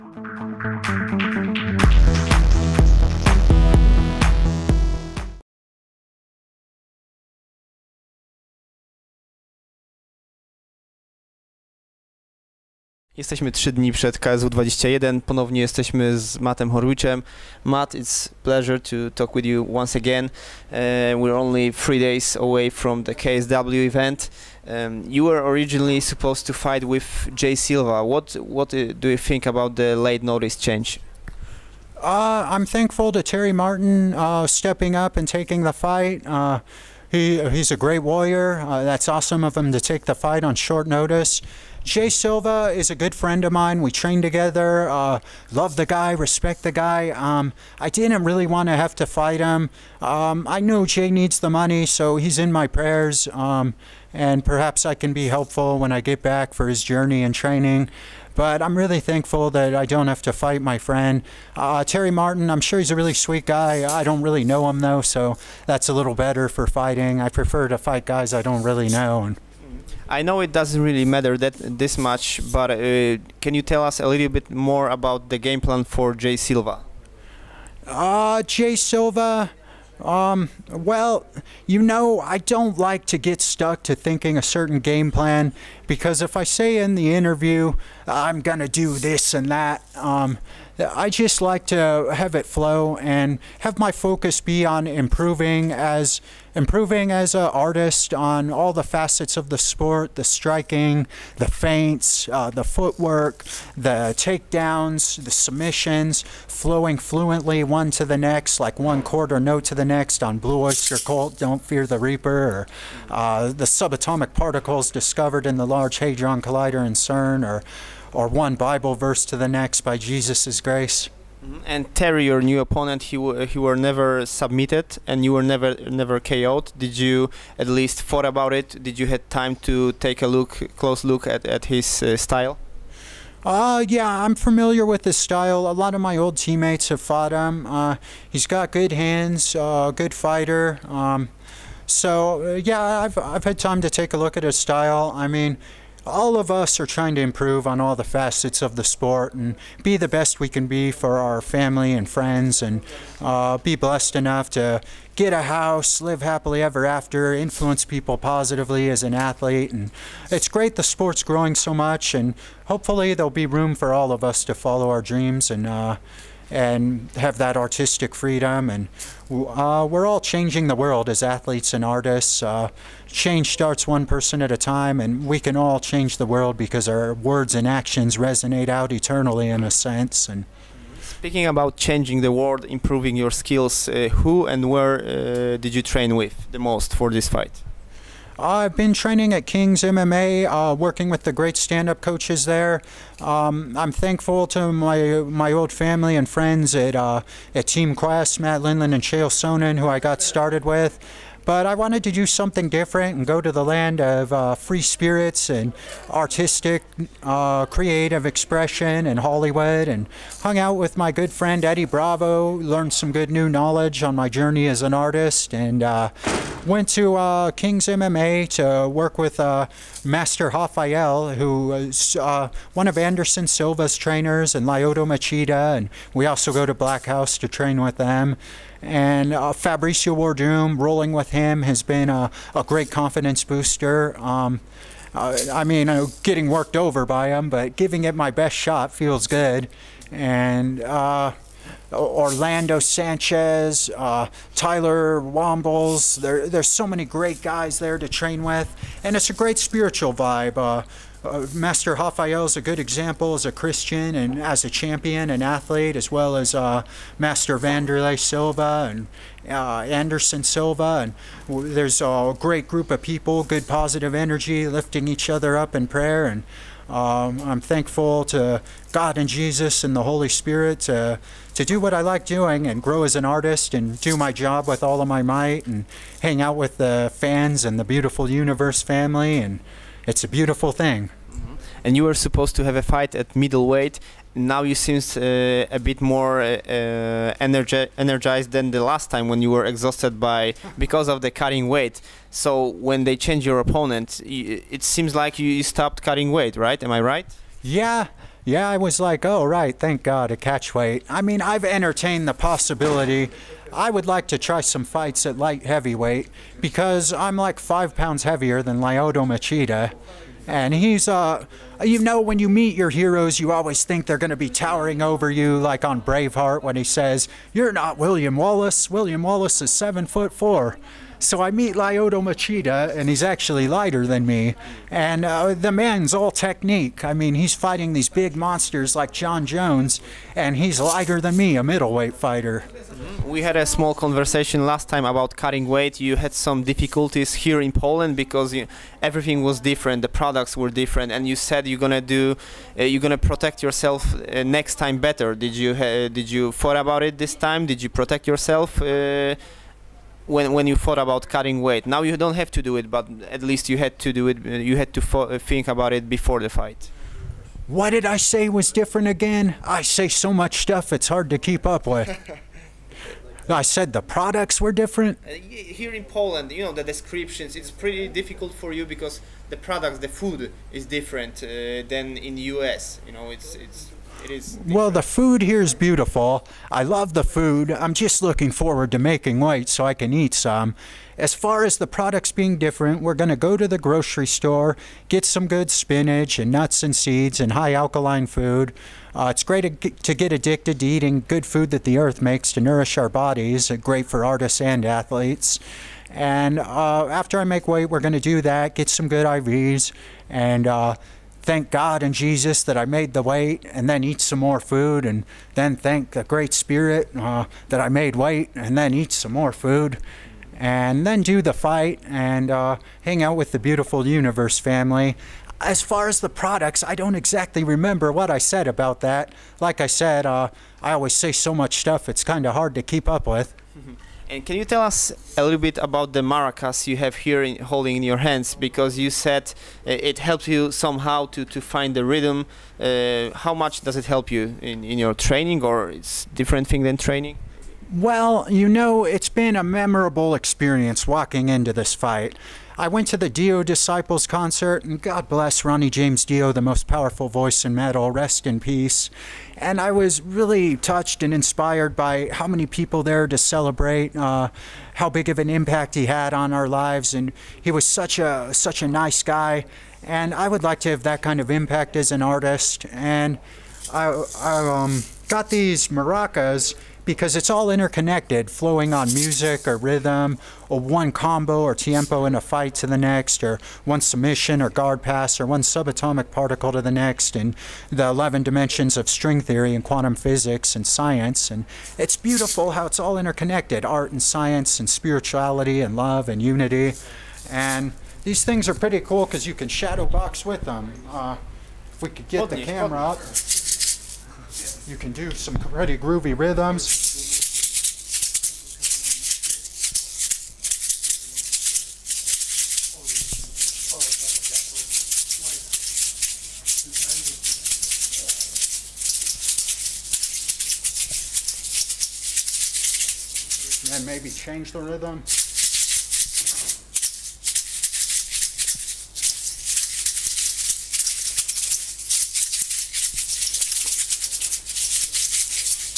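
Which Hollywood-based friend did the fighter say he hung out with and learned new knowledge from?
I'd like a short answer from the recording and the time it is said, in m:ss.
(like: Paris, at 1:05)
Eddie Bravo, at 3:31.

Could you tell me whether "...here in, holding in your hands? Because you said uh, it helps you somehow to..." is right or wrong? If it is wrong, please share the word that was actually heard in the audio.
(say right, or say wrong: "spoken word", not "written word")
right.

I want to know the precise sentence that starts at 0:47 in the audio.
Um, I didn't really want to have to fight him.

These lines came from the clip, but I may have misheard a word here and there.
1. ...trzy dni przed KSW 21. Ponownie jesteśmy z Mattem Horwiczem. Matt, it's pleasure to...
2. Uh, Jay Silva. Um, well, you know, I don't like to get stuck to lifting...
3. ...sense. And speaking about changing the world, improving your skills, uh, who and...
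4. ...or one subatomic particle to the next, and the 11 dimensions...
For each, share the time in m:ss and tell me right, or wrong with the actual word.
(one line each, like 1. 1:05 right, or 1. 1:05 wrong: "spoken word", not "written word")
1. 0:13 right
2. 1:17 wrong: "thinking", not "lifting"
3. 2:59 right
4. 7:55 right.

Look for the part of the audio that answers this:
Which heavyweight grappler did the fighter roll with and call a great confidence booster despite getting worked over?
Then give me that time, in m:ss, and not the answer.
3:49.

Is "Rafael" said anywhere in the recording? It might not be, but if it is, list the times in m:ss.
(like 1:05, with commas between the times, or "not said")
3:40, 4:11.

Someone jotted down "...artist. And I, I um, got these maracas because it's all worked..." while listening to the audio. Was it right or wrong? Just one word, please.
wrong.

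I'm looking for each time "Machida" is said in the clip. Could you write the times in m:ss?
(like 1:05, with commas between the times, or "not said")
3:45, 5:09, 5:22.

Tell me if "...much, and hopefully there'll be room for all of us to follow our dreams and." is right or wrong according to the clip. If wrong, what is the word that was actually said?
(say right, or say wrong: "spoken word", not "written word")
right.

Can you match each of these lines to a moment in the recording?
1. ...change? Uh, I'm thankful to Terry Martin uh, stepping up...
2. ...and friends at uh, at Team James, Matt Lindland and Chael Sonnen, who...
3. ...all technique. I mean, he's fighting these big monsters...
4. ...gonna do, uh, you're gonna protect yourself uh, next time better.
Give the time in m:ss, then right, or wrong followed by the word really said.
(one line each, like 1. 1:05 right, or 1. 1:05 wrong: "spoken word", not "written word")
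1. 0:30 right
2. 3:16 wrong: "Quest", not "James"
3. 5:26 right
4. 5:41 right.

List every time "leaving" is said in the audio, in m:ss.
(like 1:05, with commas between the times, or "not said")
not said.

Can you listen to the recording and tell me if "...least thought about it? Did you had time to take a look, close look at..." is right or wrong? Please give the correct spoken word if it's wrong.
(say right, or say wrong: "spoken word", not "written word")
right.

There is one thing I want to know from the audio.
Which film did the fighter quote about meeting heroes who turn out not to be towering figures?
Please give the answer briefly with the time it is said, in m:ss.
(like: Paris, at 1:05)
Braveheart, at 5:15.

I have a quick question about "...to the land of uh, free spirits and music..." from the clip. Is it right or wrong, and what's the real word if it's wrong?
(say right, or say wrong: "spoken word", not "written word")
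wrong: "artistic", not "music".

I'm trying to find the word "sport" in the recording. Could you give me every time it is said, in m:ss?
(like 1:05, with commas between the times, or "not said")
1:39, 2:28, 2:40.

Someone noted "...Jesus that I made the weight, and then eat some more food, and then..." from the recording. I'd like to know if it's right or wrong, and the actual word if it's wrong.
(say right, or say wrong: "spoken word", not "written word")
right.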